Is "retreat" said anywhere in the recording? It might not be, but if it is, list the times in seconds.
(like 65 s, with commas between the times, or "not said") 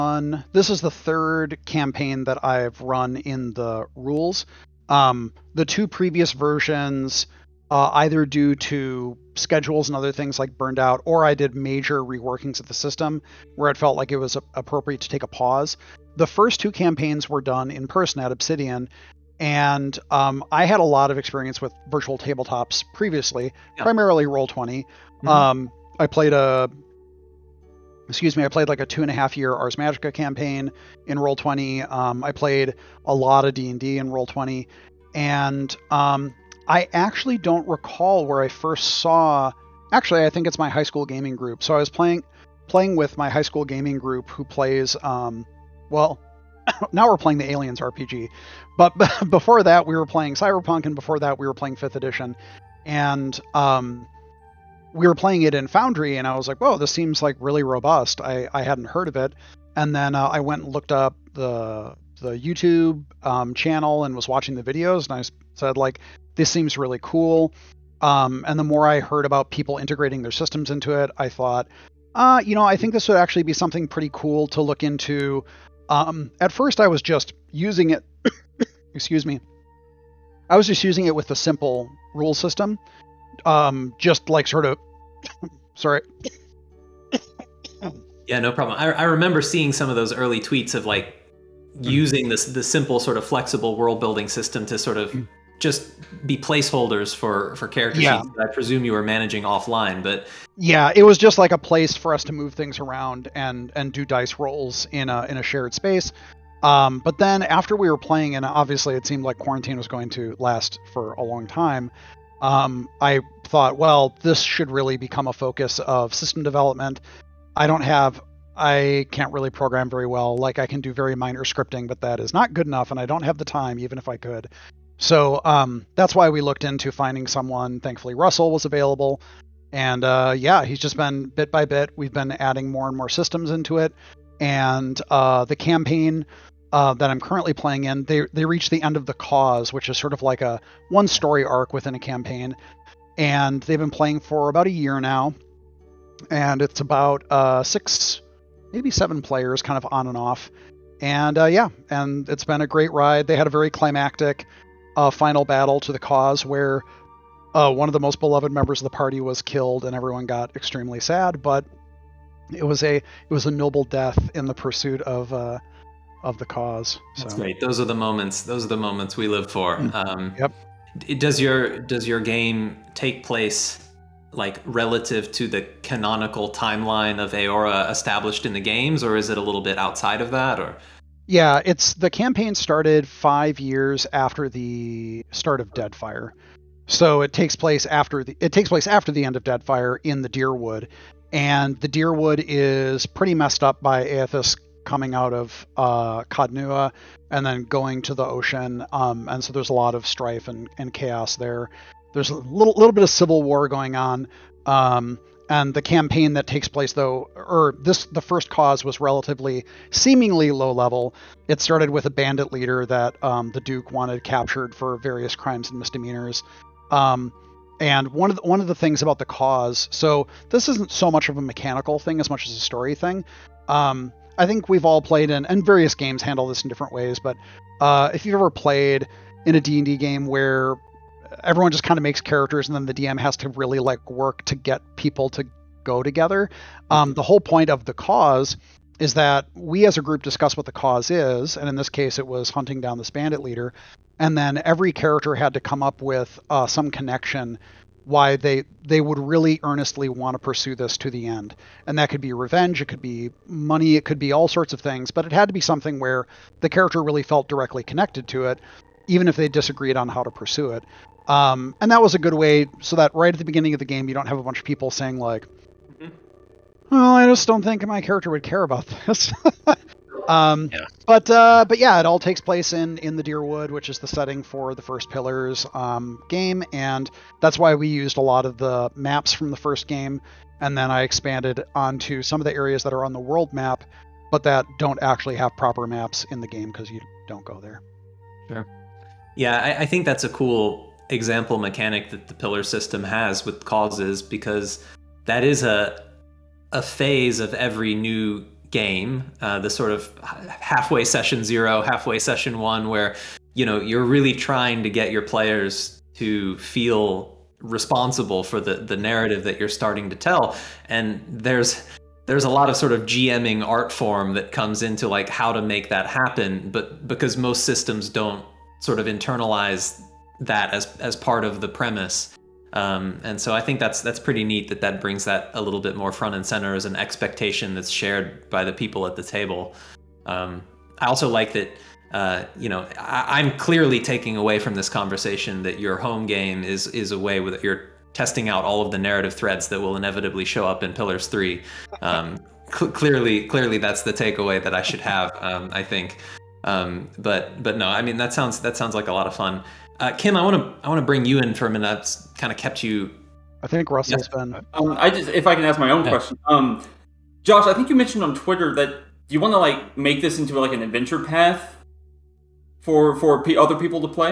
not said.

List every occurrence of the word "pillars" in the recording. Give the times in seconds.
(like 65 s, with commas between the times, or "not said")
275 s, 292 s, 340 s.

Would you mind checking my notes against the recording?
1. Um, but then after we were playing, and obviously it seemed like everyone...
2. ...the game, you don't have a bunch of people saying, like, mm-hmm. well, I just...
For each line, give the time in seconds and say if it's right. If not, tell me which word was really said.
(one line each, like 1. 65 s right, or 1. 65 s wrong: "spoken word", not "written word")
1. 106 s wrong: "quarantine", not "everyone"
2. 263 s right.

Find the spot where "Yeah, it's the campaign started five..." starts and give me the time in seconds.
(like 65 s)
181 s.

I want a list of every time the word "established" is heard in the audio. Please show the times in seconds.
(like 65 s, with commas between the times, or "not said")
177 s.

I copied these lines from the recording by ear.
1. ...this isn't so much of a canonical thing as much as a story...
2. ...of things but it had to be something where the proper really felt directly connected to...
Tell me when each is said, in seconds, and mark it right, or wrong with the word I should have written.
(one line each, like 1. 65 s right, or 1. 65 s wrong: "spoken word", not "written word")
1. 220 s wrong: "mechanical", not "canonical"
2. 254 s wrong: "character", not "proper".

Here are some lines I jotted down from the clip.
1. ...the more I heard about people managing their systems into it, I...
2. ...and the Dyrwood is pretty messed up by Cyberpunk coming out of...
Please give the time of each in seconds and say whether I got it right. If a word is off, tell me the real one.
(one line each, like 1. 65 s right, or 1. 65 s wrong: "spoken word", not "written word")
1. 68 s wrong: "integrating", not "managing"
2. 191 s wrong: "Eothas", not "Cyberpunk".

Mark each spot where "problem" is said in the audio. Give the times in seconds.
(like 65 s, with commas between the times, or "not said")
88 s.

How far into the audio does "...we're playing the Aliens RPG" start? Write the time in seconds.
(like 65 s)
47 s.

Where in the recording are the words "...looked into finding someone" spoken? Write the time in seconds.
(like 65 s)
126 s.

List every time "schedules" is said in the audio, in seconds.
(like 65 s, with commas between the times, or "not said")
9 s.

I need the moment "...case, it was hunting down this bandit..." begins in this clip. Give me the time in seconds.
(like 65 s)
241 s.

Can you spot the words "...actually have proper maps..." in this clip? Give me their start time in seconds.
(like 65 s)
285 s.